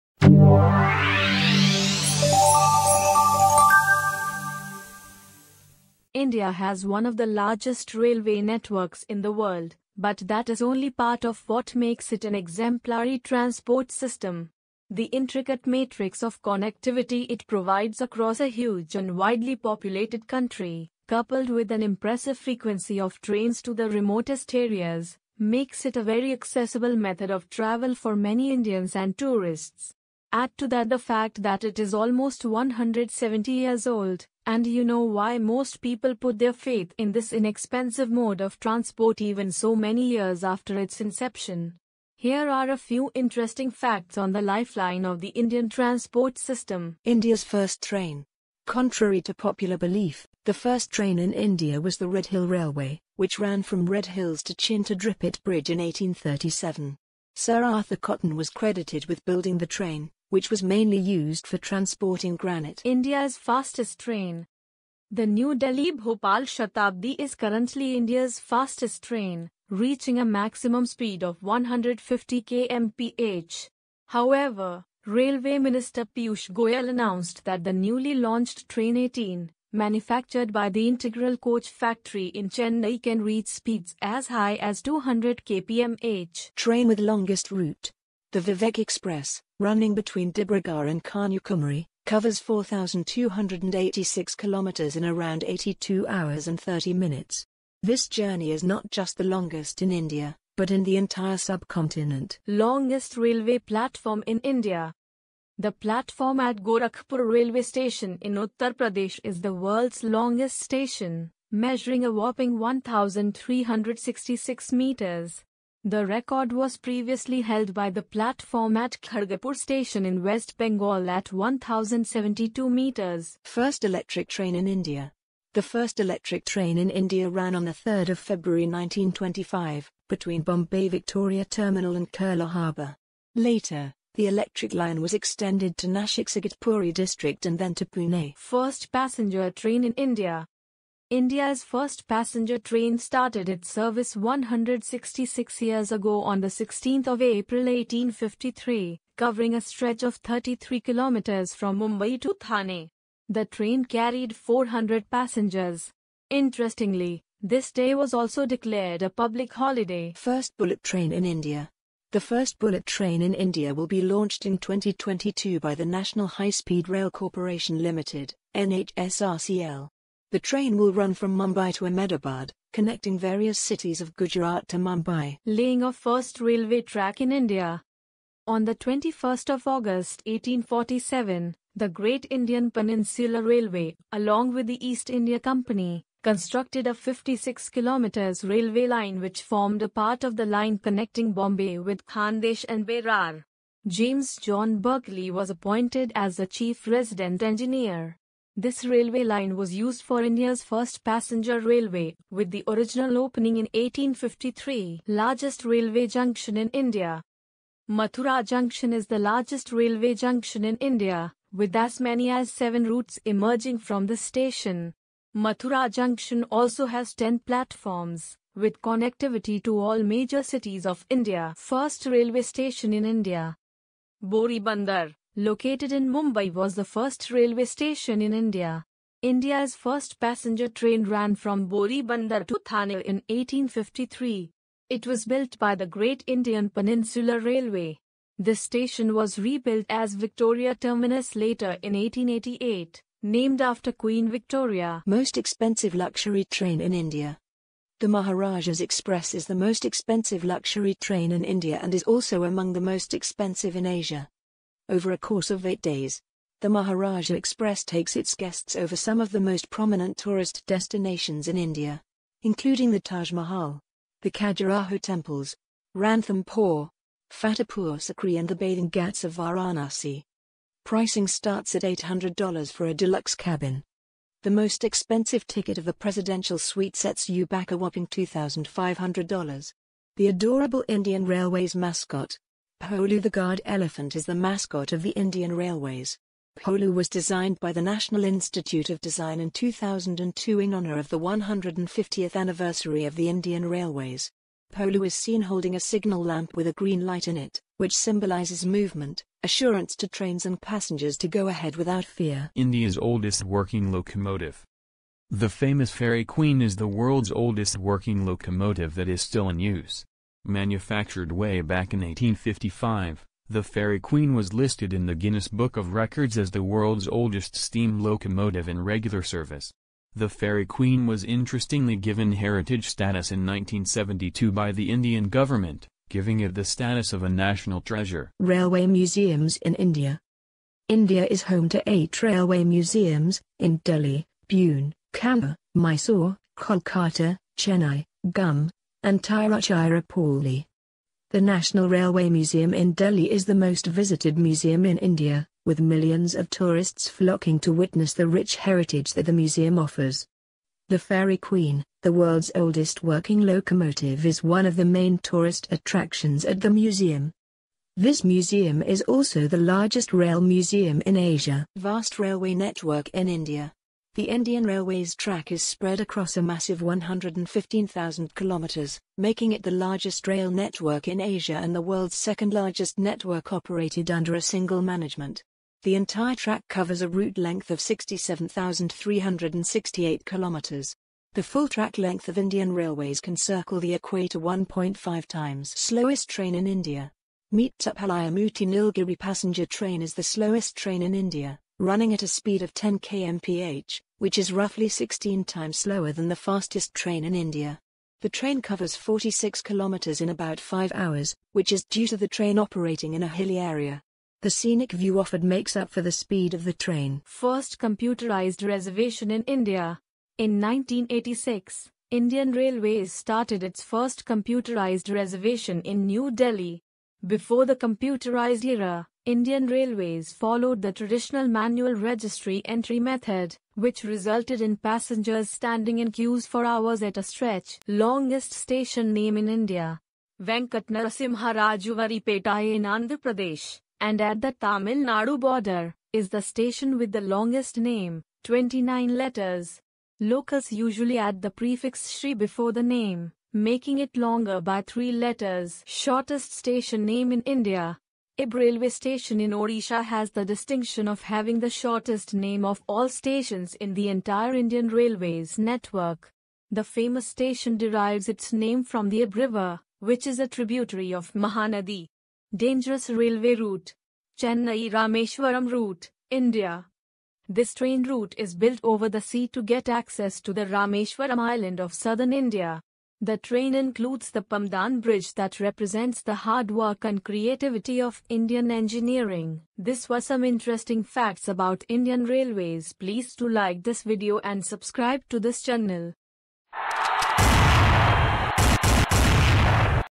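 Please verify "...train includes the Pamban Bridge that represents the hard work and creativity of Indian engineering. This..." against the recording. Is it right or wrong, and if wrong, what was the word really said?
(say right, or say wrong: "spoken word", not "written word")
right.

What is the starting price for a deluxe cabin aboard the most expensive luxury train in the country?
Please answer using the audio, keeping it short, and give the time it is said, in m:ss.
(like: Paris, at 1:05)
$800, at 4:31.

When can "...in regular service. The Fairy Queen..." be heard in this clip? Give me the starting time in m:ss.
5:18.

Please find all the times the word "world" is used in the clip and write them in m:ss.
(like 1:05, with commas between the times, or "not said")
0:09, 1:49, 5:06, 5:16, 5:52, 6:11.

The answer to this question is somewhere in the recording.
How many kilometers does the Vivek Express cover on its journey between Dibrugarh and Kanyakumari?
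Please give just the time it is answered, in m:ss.
1:32.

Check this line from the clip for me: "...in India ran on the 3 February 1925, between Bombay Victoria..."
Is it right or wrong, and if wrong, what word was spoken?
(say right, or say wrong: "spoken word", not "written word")
right.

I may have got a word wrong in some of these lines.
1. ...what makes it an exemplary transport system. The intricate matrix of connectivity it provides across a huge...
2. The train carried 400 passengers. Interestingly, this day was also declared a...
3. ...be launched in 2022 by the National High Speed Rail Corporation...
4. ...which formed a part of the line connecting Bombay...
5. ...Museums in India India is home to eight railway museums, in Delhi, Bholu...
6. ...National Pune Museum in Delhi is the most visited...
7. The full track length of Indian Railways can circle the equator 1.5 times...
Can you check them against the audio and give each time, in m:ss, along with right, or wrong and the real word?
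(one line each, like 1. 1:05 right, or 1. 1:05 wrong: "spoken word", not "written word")
1. 0:11 right
2. 2:33 right
3. 2:43 right
4. 3:09 right
5. 5:28 wrong: "Pune", not "Bholu"
6. 5:41 wrong: "Railway", not "Pune"
7. 6:21 right.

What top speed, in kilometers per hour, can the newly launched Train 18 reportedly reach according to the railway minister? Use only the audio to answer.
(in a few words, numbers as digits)
200 kmph.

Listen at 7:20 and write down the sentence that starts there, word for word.
Locals usually add the prefix Shri before the name, making it longer by three letters.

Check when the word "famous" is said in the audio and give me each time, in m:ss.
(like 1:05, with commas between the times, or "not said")
5:05, 7:36.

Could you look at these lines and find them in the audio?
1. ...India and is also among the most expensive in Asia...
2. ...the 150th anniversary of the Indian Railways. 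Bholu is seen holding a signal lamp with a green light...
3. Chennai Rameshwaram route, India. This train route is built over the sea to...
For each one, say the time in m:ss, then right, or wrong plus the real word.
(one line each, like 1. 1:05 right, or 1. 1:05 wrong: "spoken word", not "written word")
1. 4:11 right
2. 4:51 right
3. 7:44 right.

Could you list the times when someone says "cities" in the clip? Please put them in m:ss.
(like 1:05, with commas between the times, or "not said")
2:53, 3:40.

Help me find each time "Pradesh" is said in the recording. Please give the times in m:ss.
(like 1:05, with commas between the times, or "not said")
1:48, 7:13.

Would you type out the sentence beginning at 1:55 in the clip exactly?
The record was previously held by the platform at Kharagpur station in West Bengal at 1072 meters.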